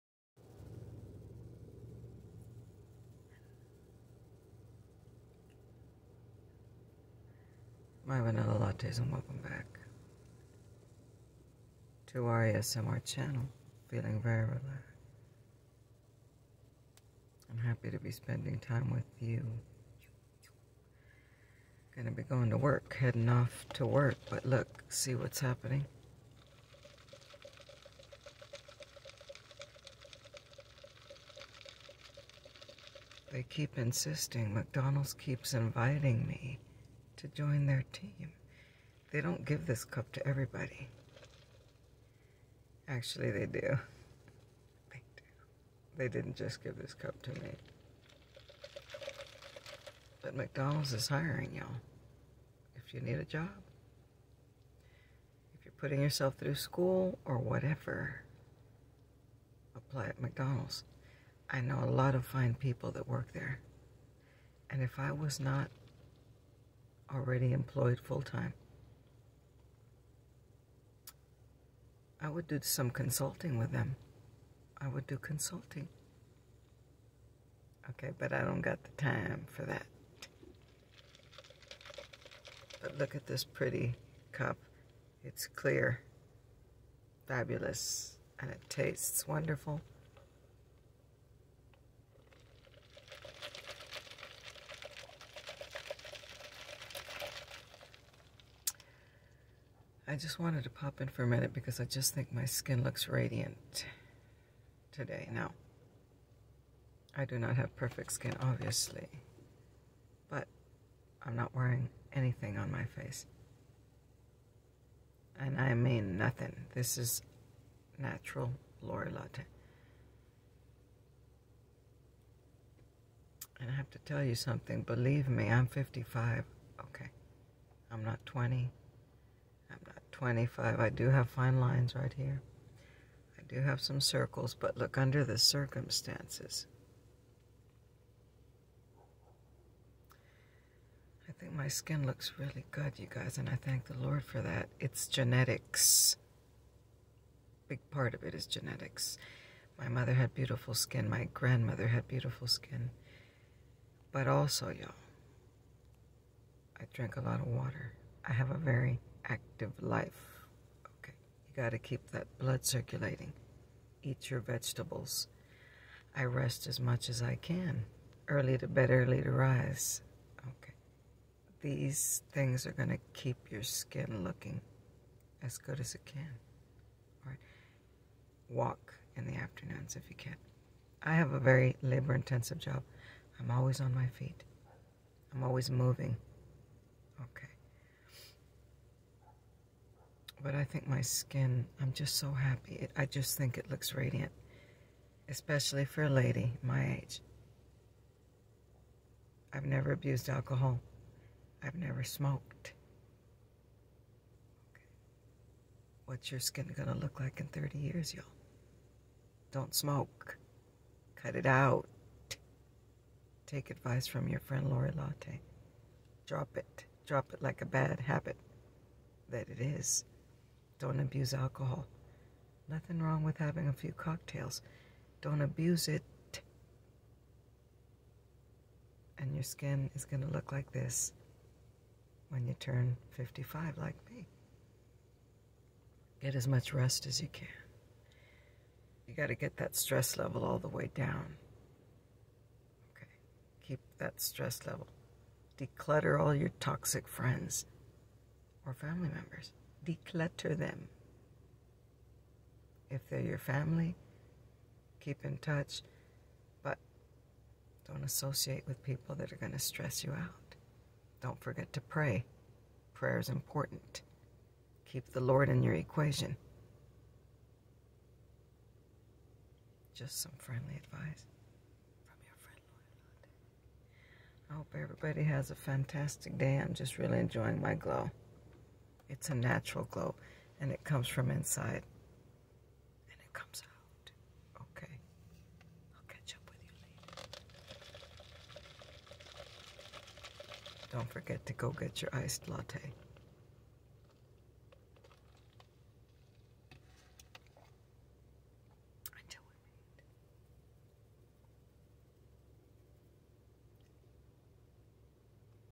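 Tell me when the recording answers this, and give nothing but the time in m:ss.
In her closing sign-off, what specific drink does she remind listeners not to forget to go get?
4:52.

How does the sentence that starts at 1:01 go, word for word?
I know a lot of fine people that work there.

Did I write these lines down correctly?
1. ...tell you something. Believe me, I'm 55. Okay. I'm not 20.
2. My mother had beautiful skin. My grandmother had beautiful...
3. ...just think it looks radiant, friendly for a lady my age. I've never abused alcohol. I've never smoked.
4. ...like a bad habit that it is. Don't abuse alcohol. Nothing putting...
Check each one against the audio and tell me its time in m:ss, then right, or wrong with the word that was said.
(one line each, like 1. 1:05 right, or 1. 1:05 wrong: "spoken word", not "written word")
1. 2:03 right
2. 2:29 right
3. 3:13 wrong: "especially", not "friendly"
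4. 3:37 wrong: "wrong", not "putting".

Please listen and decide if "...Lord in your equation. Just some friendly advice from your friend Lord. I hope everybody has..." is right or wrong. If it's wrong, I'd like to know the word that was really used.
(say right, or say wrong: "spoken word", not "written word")
right.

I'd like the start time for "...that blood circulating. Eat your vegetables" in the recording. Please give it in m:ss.
2:42.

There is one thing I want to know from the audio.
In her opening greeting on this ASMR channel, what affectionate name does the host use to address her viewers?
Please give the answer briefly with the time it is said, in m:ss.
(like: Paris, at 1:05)
Vanilla Lattes, at 0:08.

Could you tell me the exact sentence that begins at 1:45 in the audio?
Now, I do not have perfect skin, obviously, but I'm not wearing anything on my face.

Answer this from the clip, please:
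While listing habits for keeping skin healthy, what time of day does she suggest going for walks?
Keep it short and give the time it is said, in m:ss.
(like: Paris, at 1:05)
afternoons, at 2:59.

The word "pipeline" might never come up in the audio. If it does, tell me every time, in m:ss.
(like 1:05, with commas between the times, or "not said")
not said.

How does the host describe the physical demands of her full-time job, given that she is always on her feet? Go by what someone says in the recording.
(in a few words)
labor intensive.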